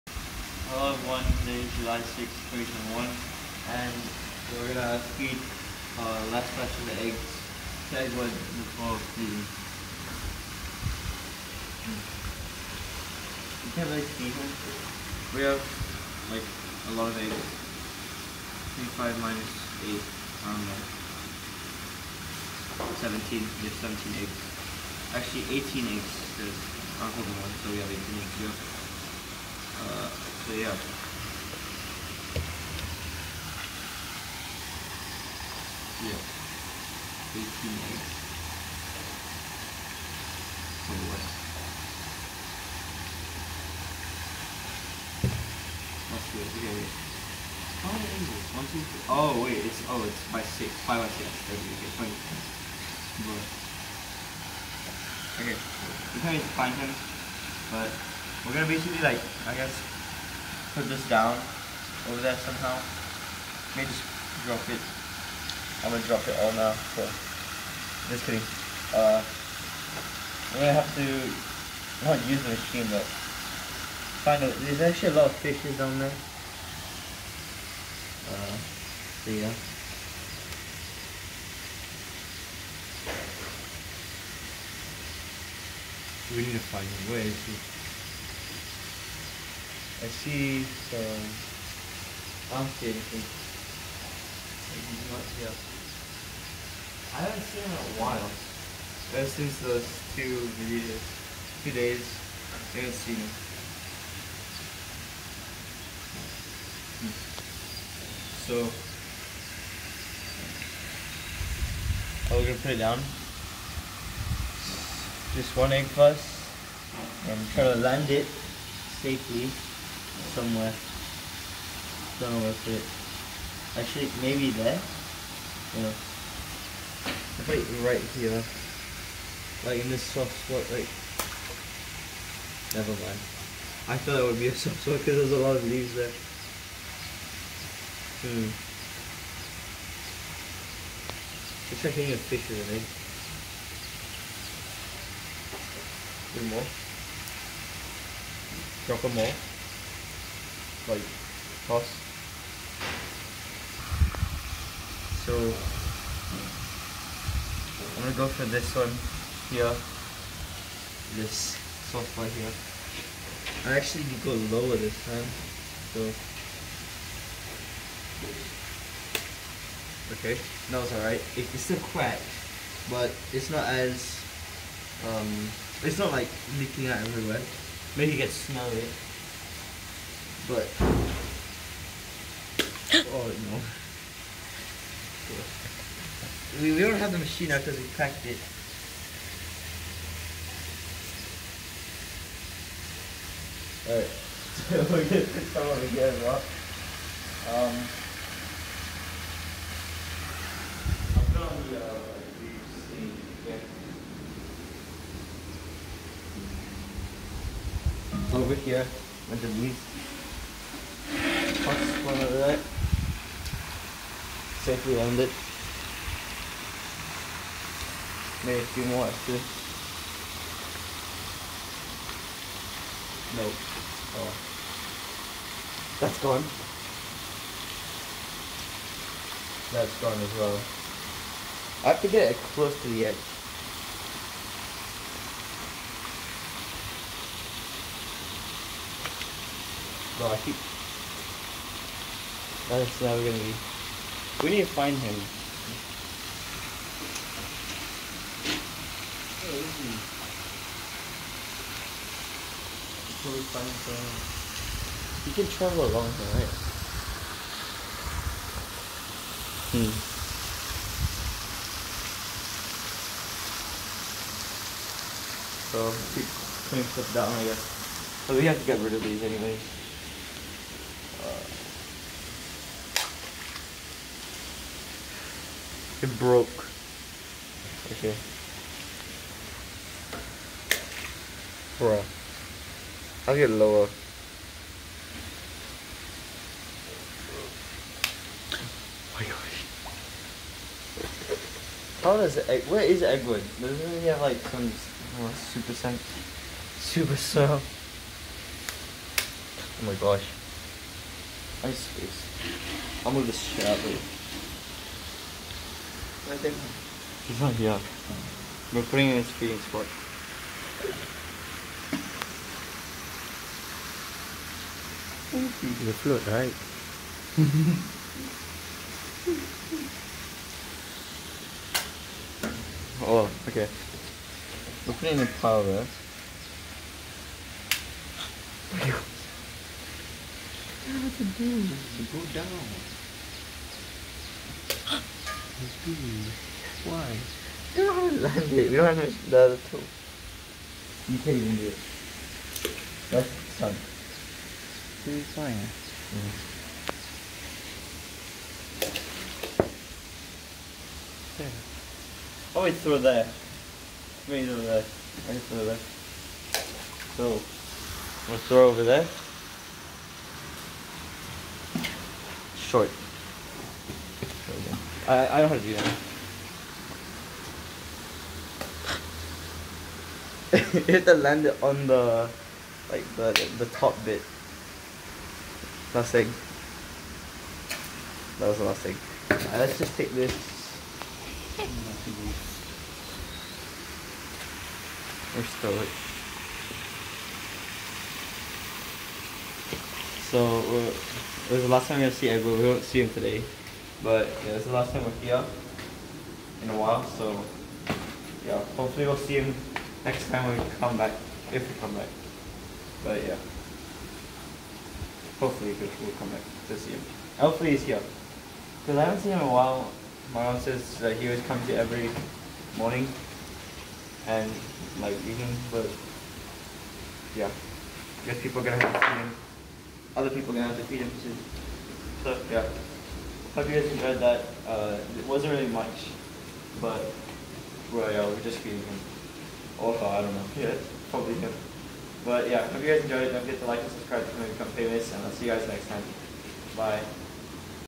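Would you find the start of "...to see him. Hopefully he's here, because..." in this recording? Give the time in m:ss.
6:46.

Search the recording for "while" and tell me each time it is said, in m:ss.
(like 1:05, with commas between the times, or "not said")
1:38, 6:36, 6:49.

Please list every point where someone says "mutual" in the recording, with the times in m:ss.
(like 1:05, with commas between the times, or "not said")
not said.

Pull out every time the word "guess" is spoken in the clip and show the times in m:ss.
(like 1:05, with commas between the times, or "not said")
0:59, 4:27, 6:58.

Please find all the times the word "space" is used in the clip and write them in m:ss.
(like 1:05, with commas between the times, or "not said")
5:01.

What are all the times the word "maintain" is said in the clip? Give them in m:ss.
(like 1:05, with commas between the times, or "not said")
not said.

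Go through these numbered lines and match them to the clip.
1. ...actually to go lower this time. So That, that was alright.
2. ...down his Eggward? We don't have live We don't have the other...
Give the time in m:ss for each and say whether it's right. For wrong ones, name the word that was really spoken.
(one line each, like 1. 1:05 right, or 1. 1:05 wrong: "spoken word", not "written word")
1. 2:43 wrong: "Okay", not "That"
2. 5:32 wrong: "Why", not "Eggward".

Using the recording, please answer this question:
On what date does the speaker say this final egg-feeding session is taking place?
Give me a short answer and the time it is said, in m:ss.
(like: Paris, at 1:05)
July 6, 2021, at 0:01.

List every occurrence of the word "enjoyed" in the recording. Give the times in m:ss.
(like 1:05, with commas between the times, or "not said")
7:03, 7:13.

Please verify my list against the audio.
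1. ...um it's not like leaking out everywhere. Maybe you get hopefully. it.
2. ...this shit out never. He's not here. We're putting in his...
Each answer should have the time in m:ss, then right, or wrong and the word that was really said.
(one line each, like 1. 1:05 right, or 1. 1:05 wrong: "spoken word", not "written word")
1. 2:55 wrong: "smelly", not "hopefully"
2. 5:03 wrong: "later", not "never".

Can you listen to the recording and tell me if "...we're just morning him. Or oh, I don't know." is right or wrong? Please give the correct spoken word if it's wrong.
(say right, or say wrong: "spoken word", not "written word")
wrong: "feeding", not "morning".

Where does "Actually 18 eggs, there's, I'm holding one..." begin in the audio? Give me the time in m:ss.
0:25.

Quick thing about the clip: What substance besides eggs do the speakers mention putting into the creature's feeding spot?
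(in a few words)
Powder.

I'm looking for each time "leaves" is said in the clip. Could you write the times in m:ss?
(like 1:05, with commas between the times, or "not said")
2:15, 3:29.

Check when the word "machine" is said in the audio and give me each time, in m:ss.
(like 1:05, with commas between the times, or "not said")
1:12, 3:07.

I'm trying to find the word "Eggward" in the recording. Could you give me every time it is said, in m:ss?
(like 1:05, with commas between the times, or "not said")
4:53, 6:32.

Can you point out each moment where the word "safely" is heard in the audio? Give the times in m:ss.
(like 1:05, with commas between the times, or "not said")
1:58, 3:34.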